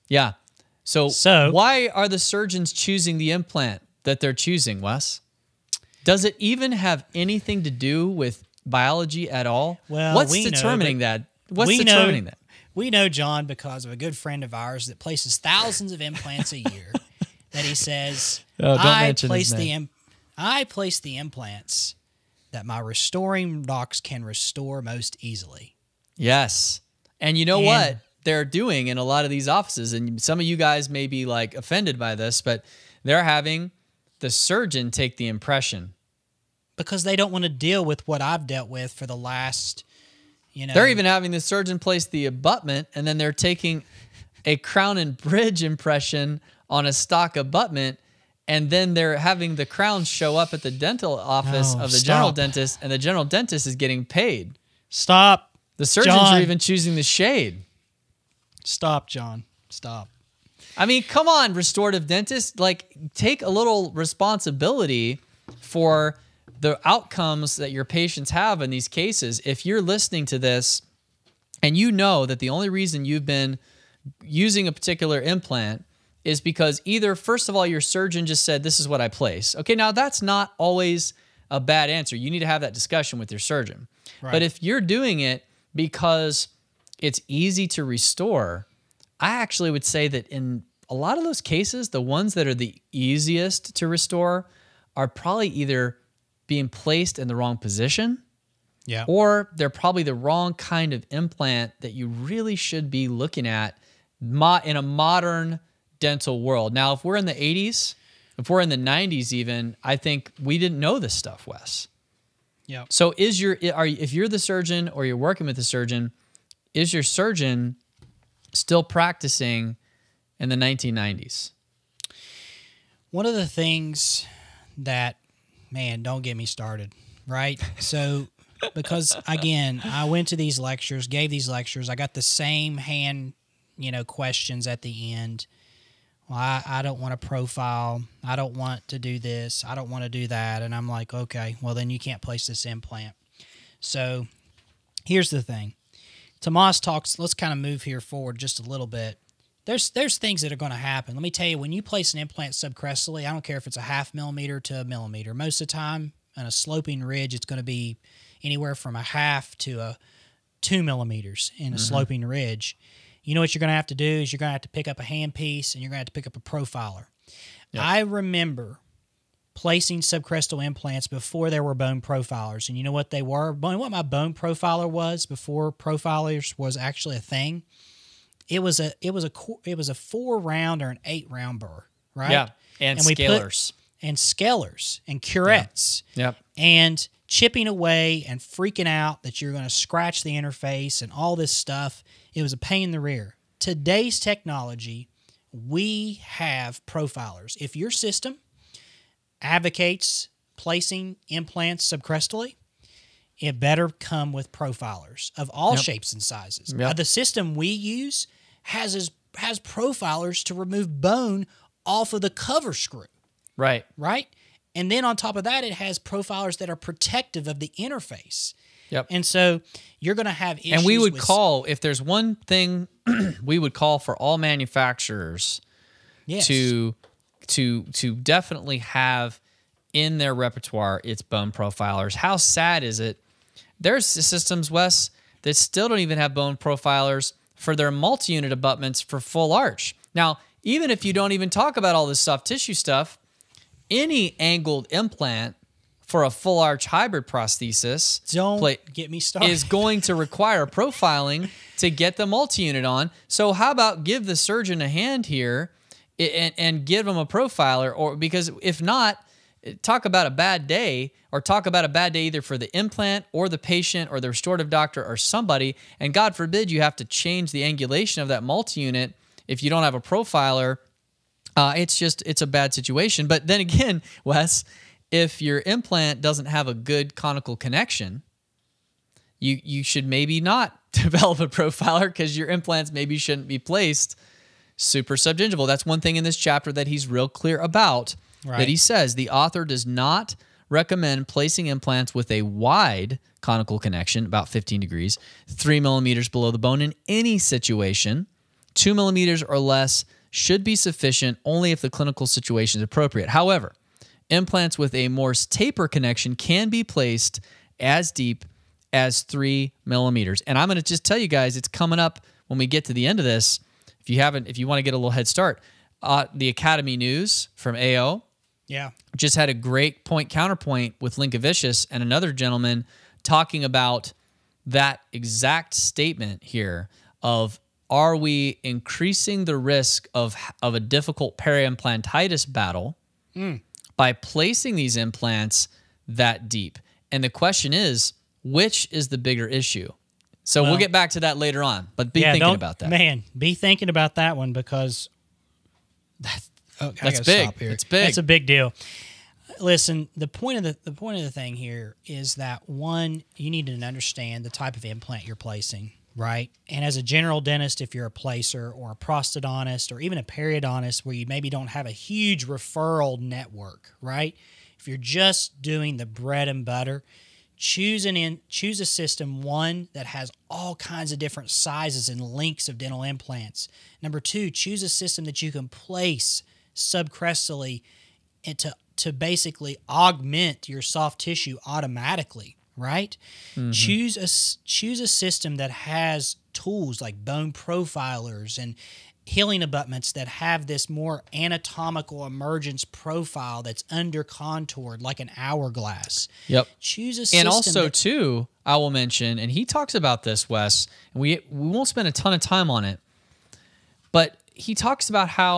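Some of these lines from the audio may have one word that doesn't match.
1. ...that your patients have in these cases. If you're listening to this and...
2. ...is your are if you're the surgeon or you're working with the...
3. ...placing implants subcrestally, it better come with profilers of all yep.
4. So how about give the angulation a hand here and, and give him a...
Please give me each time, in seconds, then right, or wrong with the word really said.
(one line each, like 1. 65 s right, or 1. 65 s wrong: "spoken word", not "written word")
1. 67 s right
2. 113 s right
3. 200 s right
4. 253 s wrong: "surgeon", not "angulation".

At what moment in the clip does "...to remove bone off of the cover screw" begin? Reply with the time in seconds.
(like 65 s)
210 s.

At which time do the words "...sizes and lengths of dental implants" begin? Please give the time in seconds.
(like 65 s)
371 s.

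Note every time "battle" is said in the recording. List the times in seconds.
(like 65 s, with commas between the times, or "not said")
332 s.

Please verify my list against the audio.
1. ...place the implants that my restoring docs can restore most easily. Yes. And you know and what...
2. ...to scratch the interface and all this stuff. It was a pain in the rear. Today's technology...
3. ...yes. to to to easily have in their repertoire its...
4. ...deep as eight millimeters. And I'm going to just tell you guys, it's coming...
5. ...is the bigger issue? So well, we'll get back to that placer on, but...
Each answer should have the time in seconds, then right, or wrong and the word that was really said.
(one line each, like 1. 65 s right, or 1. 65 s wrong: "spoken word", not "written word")
1. 20 s right
2. 189 s right
3. 226 s wrong: "definitely", not "easily"
4. 308 s wrong: "three", not "eight"
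5. 338 s wrong: "later", not "placer".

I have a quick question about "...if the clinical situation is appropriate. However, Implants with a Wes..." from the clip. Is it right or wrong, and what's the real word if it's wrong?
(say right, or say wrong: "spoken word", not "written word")
wrong: "Morse", not "Wes".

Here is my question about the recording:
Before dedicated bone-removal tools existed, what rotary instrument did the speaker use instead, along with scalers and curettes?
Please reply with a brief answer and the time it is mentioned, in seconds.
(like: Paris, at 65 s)
Round burr, at 181 s.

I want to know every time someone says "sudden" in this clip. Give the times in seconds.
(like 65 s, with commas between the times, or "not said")
not said.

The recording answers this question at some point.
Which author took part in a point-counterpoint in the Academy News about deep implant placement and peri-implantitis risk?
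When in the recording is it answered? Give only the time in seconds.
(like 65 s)
321 s.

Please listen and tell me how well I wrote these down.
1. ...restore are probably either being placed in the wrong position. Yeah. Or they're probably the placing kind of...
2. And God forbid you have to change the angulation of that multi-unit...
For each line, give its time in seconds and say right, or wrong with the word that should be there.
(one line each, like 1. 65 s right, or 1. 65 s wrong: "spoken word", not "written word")
1. 93 s wrong: "wrong", not "placing"
2. 266 s right.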